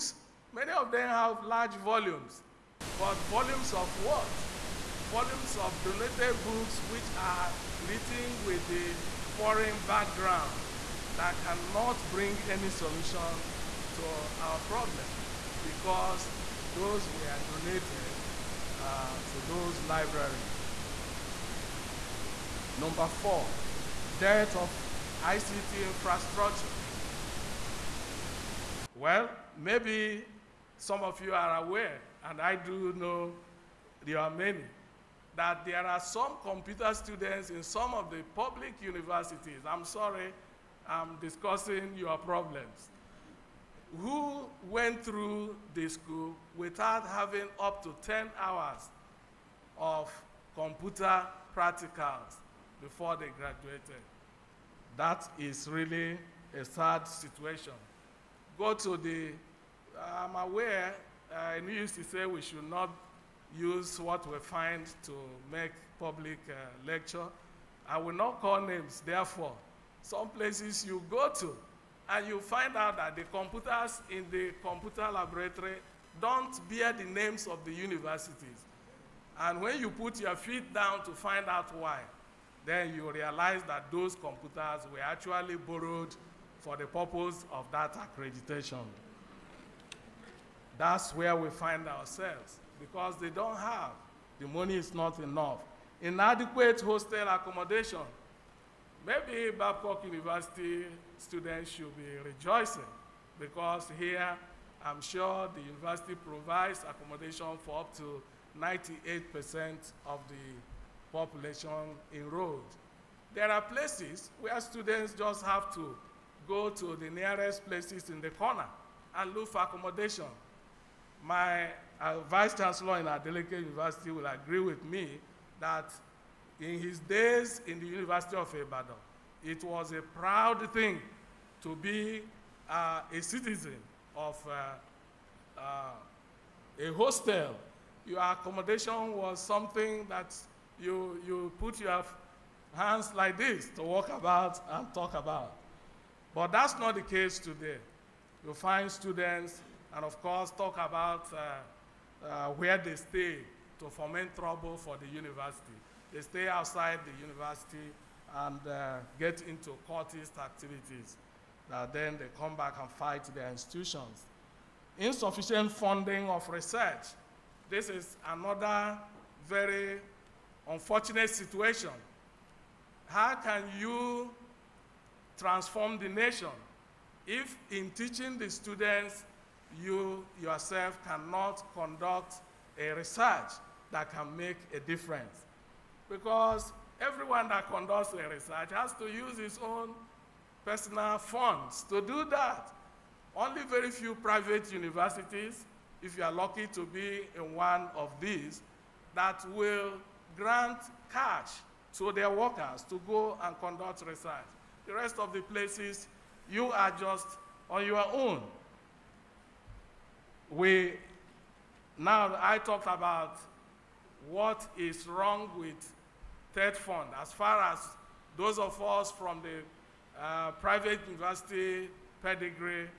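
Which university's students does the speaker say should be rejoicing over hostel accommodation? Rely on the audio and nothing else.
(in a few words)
Babcock University.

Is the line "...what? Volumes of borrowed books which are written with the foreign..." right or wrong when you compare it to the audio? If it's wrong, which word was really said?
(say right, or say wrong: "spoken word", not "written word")
wrong: "donated", not "borrowed".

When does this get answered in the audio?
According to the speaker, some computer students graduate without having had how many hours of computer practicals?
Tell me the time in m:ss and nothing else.
0:48.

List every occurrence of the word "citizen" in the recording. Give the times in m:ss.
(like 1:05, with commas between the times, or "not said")
2:13.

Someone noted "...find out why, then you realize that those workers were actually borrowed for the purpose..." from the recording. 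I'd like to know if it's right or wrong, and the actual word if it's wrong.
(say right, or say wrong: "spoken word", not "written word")
wrong: "computers", not "workers".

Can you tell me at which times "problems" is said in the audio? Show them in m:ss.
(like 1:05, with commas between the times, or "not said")
0:14, 0:42.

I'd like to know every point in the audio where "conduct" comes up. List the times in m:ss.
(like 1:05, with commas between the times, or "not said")
3:01, 3:07, 3:23.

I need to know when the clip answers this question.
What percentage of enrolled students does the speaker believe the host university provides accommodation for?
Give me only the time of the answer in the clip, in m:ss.
1:48.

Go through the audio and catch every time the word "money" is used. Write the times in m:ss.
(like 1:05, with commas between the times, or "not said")
1:34.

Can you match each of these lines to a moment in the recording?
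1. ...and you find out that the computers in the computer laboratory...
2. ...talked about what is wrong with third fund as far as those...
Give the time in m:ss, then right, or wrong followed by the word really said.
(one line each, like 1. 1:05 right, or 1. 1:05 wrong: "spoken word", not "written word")
1. 1:12 right
2. 3:32 right.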